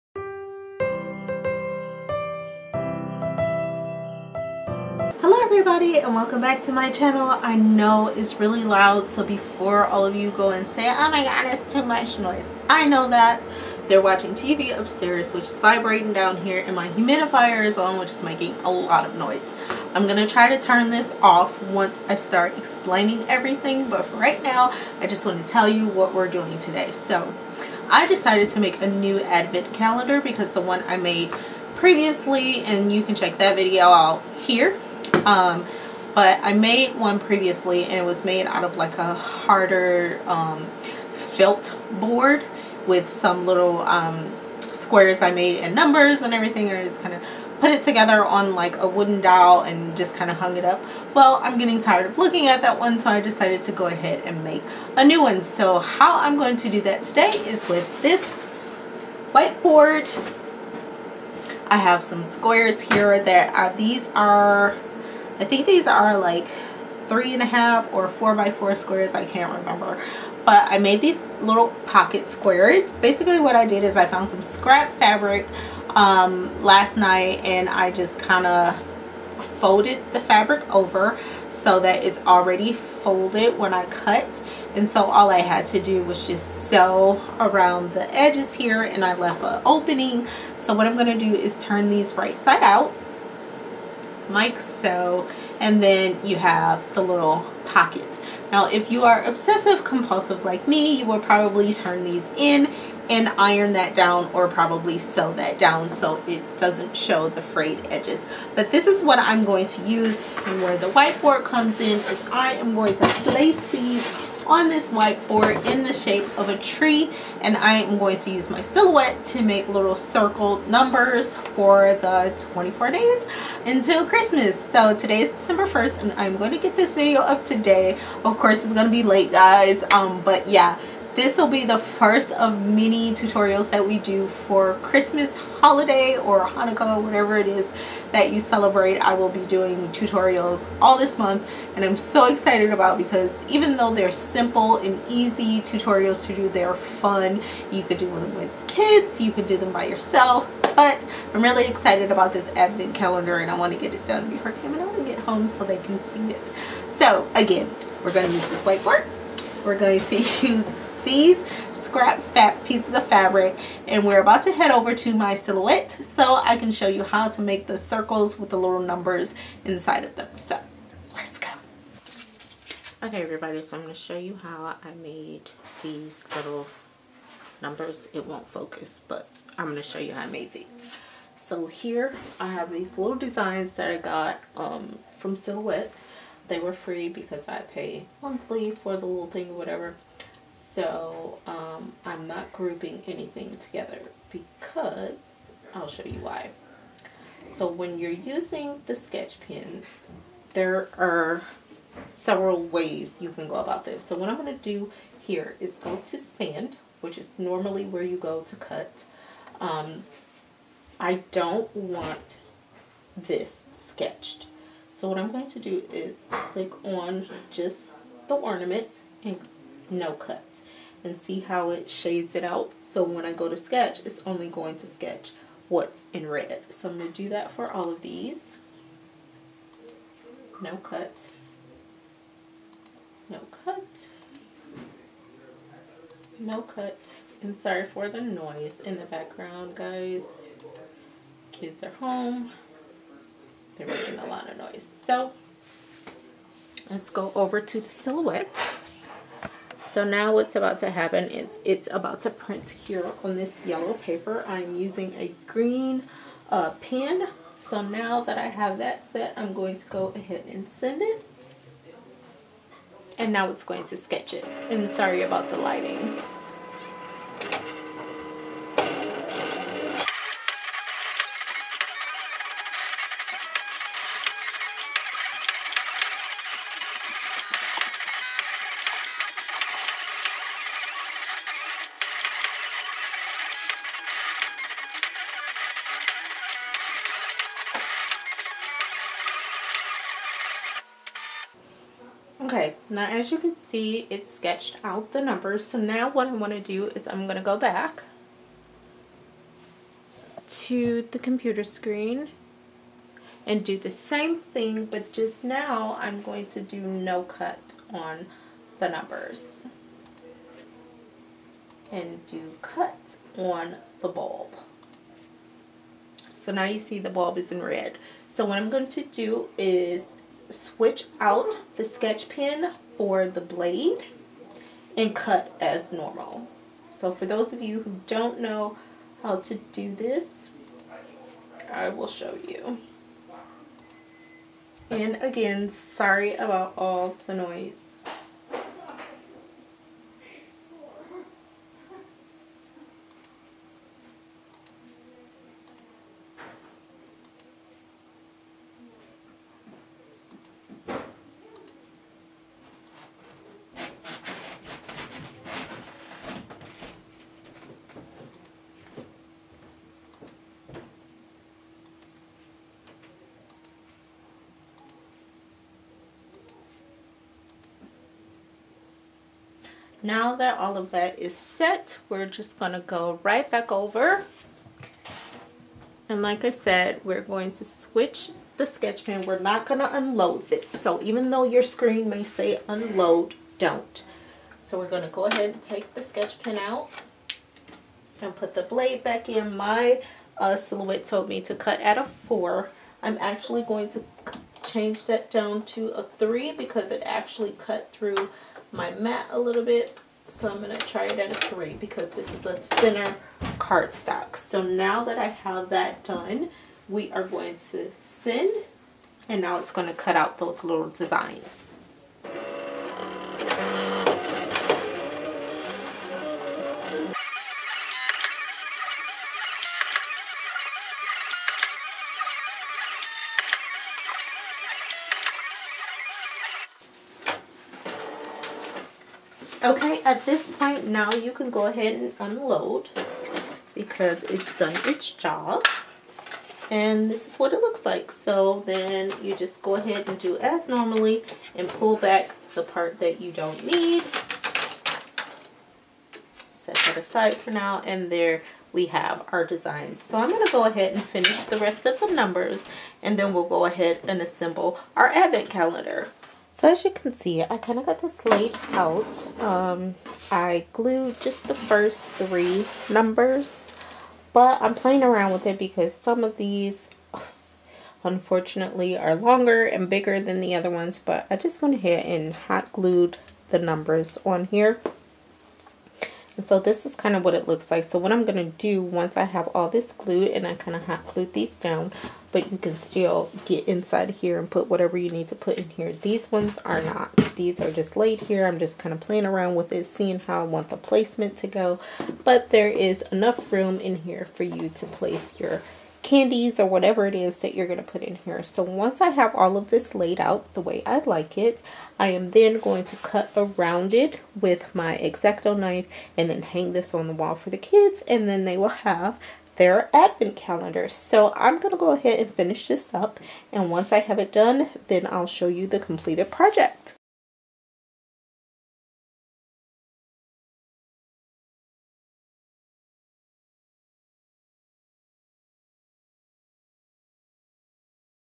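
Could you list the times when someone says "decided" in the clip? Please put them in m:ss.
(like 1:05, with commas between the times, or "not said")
0:28, 0:53.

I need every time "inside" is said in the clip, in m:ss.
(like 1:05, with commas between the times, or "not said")
2:49, 8:03.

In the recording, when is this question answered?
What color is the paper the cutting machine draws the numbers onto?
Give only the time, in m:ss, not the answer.
4:13.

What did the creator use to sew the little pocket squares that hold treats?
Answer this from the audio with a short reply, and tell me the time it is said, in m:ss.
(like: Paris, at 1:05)
scrap fabric, at 1:14.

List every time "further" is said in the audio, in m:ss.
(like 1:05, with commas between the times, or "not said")
not said.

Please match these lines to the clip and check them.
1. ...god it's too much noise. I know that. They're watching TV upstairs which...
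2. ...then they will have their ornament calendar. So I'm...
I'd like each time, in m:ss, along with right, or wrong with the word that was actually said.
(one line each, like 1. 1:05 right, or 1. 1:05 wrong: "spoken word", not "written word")
1. 0:11 right
2. 8:28 wrong: "advent", not "ornament".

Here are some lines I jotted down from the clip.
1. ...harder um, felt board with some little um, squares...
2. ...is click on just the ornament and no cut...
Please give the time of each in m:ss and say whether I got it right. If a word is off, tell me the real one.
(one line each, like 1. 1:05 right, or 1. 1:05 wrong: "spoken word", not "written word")
1. 0:39 right
2. 3:35 right.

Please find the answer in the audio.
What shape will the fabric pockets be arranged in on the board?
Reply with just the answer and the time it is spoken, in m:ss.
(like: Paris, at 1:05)
a tree, at 1:55.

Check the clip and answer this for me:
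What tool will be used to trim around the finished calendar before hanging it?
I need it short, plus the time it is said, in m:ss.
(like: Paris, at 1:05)
X-Acto knife, at 8:24.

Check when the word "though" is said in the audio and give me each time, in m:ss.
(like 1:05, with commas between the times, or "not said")
2:23, 6:21.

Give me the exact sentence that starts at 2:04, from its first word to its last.
So today is December 1st and I'm going to get this video up today.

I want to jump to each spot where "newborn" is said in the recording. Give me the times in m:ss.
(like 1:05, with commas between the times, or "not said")
not said.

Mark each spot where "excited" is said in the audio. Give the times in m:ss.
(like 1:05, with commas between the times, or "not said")
2:22, 2:31.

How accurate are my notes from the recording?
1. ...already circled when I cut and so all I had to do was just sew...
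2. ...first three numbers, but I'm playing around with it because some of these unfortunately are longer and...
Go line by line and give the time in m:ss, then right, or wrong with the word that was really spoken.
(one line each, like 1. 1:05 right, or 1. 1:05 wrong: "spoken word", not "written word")
1. 1:22 wrong: "folded", not "circled"
2. 7:41 right.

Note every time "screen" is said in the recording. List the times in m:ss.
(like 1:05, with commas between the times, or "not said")
5:01, 6:21.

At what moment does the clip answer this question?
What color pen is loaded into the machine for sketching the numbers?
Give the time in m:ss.
4:15.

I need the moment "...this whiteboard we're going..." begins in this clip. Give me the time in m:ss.
2:38.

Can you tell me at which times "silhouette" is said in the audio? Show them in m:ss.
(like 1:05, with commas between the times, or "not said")
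1:58, 2:45, 3:05, 4:07, 6:30.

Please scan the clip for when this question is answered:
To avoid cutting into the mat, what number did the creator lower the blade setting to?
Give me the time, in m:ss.
6:36.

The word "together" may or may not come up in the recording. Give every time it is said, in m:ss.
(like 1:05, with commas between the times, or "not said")
0:47, 3:13.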